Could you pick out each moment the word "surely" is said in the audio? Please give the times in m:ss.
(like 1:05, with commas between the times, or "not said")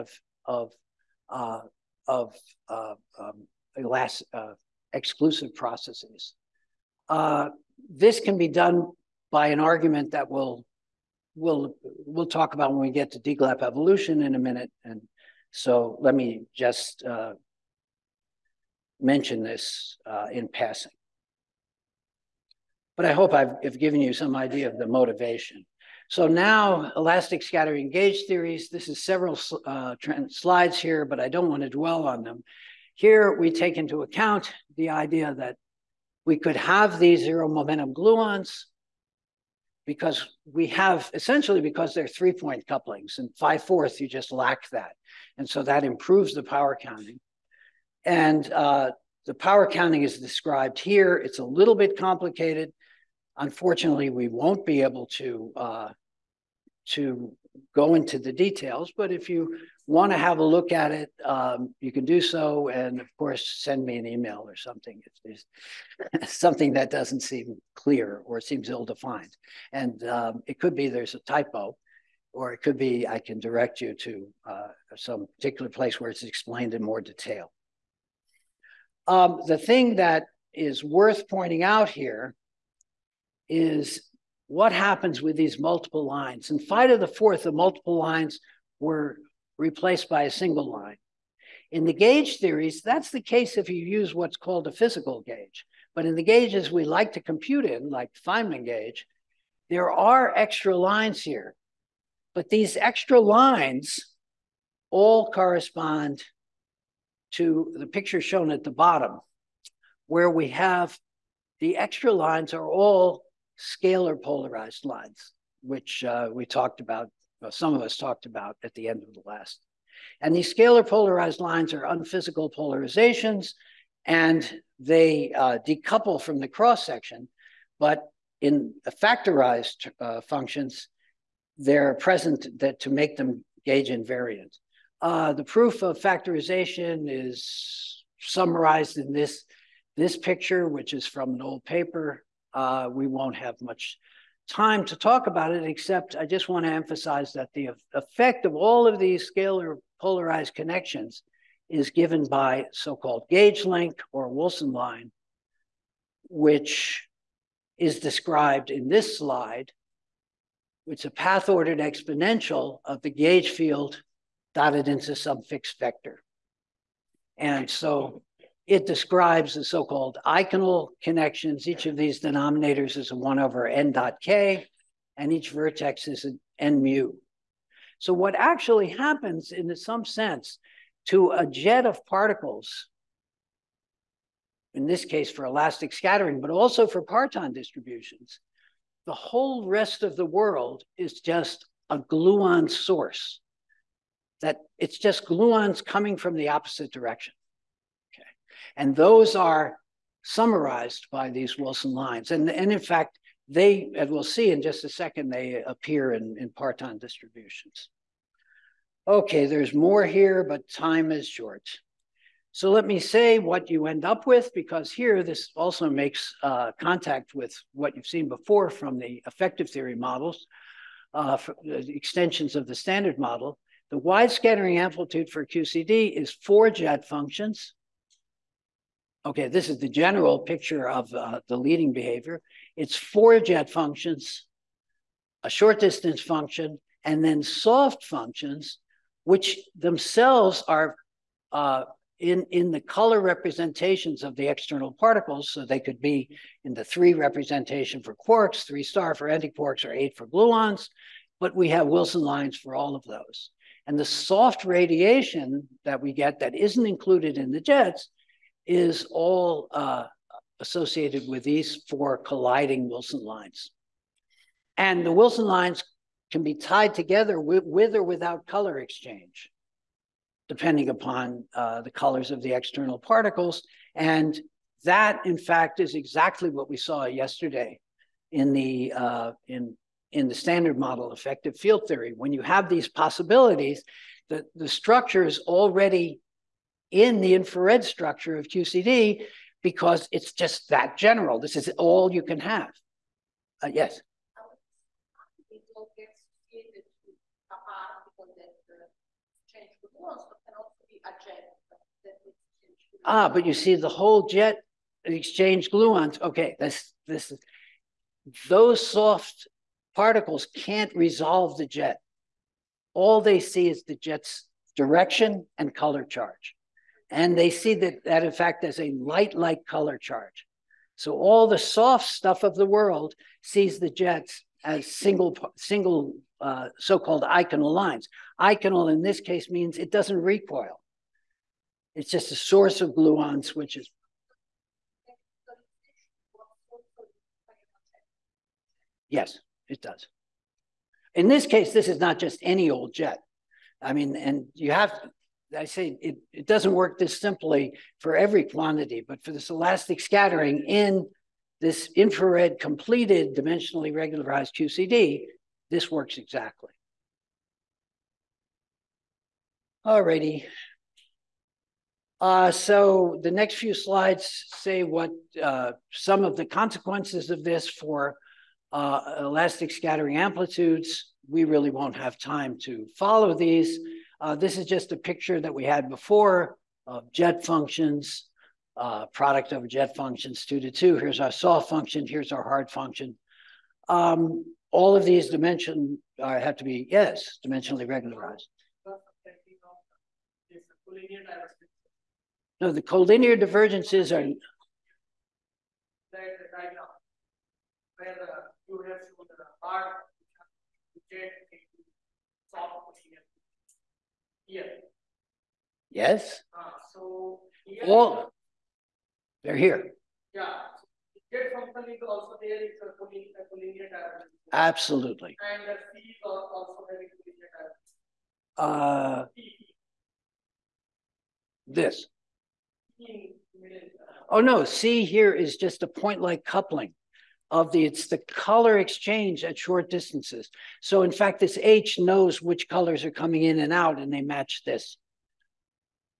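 not said.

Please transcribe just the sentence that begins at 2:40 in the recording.
It's a path-ordered exponential of the gauge field dotted into some fixed vector.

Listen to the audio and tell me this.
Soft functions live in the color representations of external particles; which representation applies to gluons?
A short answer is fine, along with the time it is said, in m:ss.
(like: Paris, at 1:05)
Eight, at 4:09.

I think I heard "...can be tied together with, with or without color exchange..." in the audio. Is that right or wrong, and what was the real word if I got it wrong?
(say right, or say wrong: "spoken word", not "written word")
right.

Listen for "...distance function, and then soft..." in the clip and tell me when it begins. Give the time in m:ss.
3:55.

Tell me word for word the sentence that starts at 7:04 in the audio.
Oh no, C here is just a point like coupling of the, it's the color exchange at short distances.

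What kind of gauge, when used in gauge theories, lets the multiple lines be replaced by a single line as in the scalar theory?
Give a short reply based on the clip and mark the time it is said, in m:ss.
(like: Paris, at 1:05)
Physical gauge, at 1:34.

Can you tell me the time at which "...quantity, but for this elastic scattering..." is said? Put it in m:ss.
5:48.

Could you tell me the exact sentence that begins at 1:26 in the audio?
In of the Fourth, the multiple lines were replaced by a single line.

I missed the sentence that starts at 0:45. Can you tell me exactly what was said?
And so that improves the power counting.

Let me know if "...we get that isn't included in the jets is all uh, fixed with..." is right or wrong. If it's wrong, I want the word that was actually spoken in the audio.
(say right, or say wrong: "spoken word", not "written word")
wrong: "associated", not "fixed".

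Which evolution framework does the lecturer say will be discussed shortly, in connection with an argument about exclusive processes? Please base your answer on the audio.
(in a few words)
DGLAP evolution.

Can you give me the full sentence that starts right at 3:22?
And, and in fact, they, and we'll see in just a second, they appear in, in parton distributions.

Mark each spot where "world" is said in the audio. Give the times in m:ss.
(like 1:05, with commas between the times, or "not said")
3:10, 5:22.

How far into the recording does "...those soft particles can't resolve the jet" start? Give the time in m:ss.
5:08.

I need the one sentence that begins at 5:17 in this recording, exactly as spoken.
And they see that, that in fact, as a light, light color charge.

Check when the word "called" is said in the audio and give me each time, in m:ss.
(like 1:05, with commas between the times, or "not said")
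1:34, 2:32, 2:49, 5:26.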